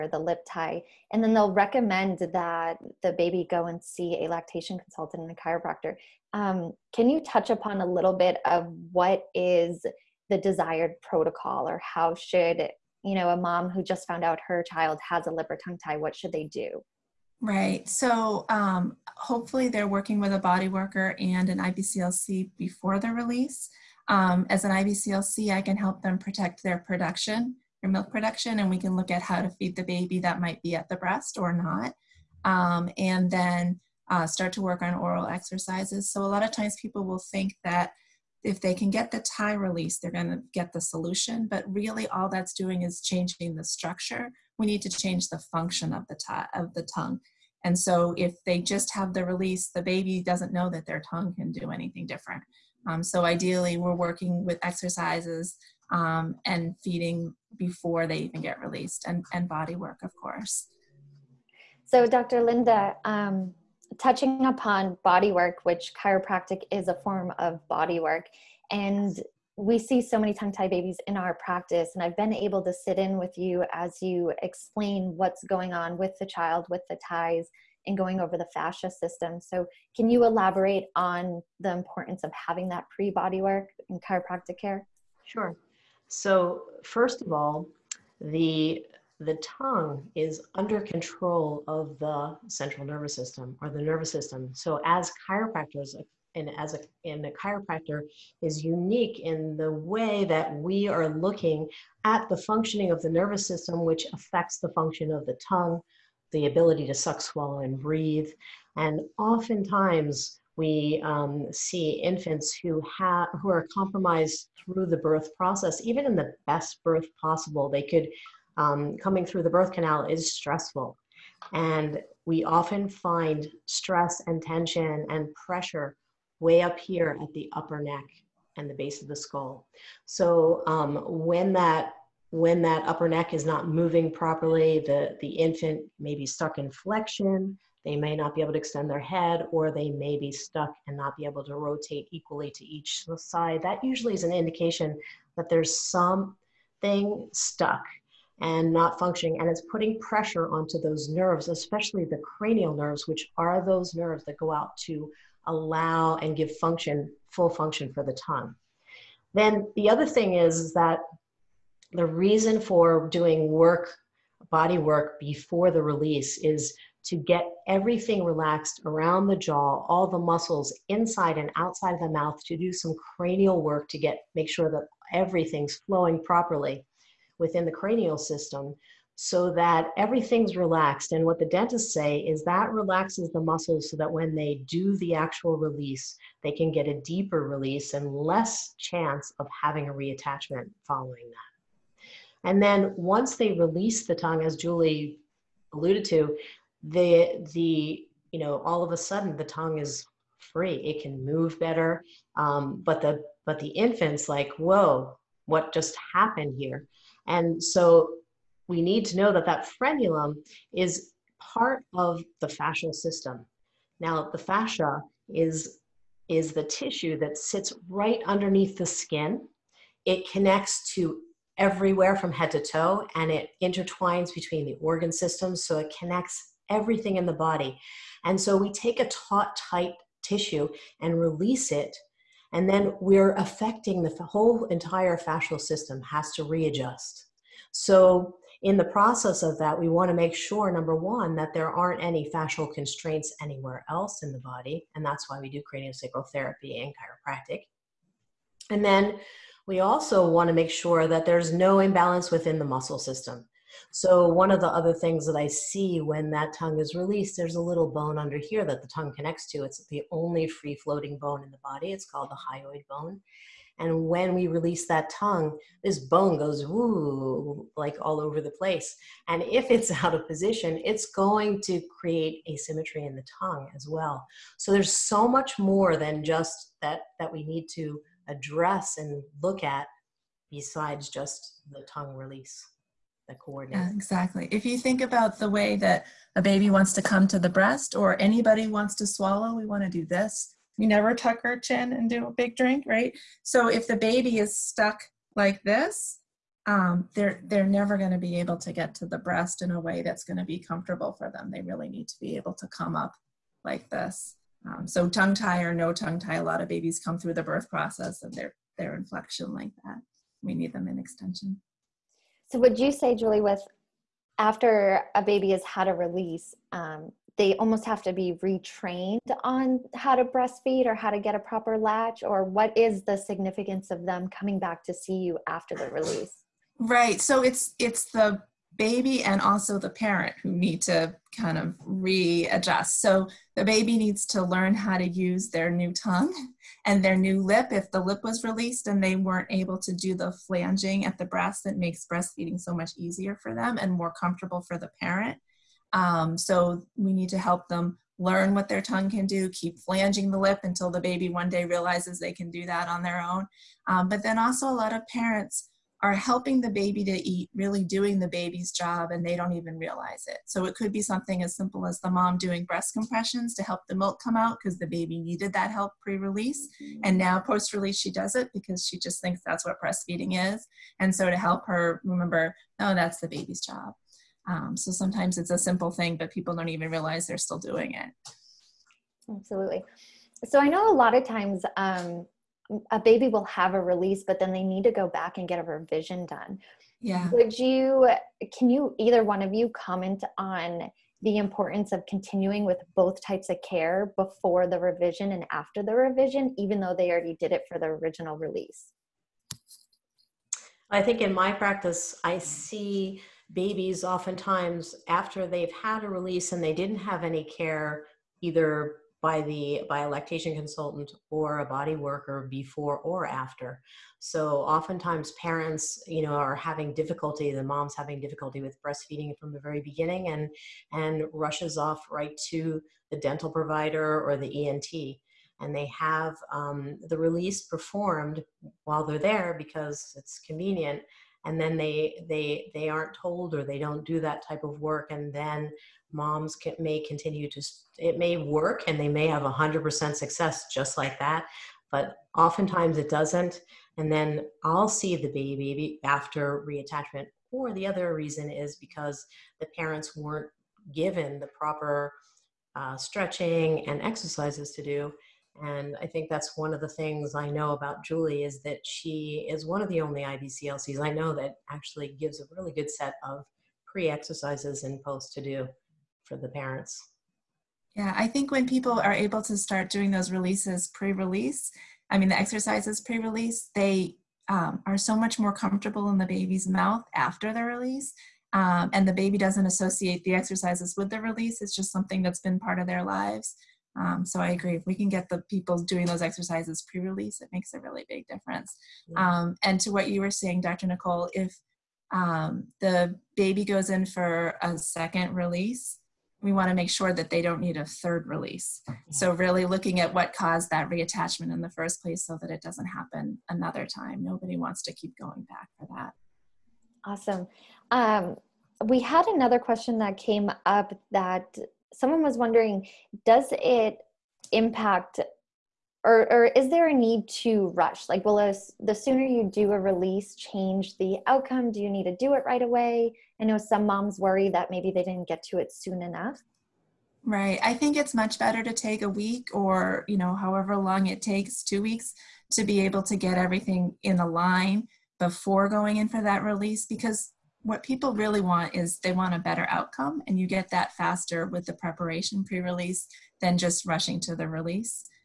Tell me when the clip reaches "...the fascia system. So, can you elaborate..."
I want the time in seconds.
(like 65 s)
78 s.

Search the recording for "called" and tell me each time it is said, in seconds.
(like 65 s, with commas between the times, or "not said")
262 s.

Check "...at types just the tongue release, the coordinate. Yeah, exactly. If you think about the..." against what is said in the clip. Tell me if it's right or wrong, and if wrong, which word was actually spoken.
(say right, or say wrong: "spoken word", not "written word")
wrong: "besides", not "types".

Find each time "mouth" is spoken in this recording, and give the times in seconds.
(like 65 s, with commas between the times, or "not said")
172 s, 476 s.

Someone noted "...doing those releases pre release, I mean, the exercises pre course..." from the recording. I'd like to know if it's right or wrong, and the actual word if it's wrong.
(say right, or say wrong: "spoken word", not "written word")
wrong: "release", not "course".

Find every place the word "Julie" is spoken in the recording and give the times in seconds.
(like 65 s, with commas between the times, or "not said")
194 s, 313 s, 458 s.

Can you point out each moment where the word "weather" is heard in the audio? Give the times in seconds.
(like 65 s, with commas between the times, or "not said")
not said.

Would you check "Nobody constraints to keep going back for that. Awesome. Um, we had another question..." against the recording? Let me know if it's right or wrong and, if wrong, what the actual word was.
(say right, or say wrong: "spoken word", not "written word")
wrong: "wants", not "constraints".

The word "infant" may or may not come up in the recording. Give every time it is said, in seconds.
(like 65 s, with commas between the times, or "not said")
112 s, 135 s, 203 s.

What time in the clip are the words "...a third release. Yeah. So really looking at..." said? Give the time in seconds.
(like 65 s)
497 s.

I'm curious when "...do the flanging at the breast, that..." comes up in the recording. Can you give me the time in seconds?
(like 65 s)
339 s.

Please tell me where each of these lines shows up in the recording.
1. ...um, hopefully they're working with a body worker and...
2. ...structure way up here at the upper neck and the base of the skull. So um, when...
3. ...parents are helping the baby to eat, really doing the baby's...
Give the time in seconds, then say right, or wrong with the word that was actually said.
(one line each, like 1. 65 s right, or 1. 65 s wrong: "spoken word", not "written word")
1. 18 s right
2. 125 s wrong: "pressure", not "structure"
3. 355 s right.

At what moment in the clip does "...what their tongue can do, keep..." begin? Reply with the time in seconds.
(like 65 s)
348 s.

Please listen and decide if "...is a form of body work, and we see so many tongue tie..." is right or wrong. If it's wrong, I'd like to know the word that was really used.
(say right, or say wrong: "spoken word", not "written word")
right.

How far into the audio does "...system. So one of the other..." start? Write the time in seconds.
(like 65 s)
252 s.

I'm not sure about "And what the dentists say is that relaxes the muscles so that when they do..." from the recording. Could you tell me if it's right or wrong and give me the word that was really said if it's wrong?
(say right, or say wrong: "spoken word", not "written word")
right.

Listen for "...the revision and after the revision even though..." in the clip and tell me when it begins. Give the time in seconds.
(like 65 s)
394 s.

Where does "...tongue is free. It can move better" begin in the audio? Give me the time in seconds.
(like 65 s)
199 s.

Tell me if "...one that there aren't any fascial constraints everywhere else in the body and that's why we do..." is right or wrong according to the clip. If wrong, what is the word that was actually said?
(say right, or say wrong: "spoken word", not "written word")
wrong: "anywhere", not "everywhere".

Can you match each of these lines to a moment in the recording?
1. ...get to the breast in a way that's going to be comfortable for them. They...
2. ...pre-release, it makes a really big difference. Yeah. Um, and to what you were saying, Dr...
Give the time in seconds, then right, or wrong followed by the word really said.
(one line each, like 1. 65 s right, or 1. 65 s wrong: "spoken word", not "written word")
1. 298 s right
2. 486 s right.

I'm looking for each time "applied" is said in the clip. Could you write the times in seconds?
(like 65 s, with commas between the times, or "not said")
not said.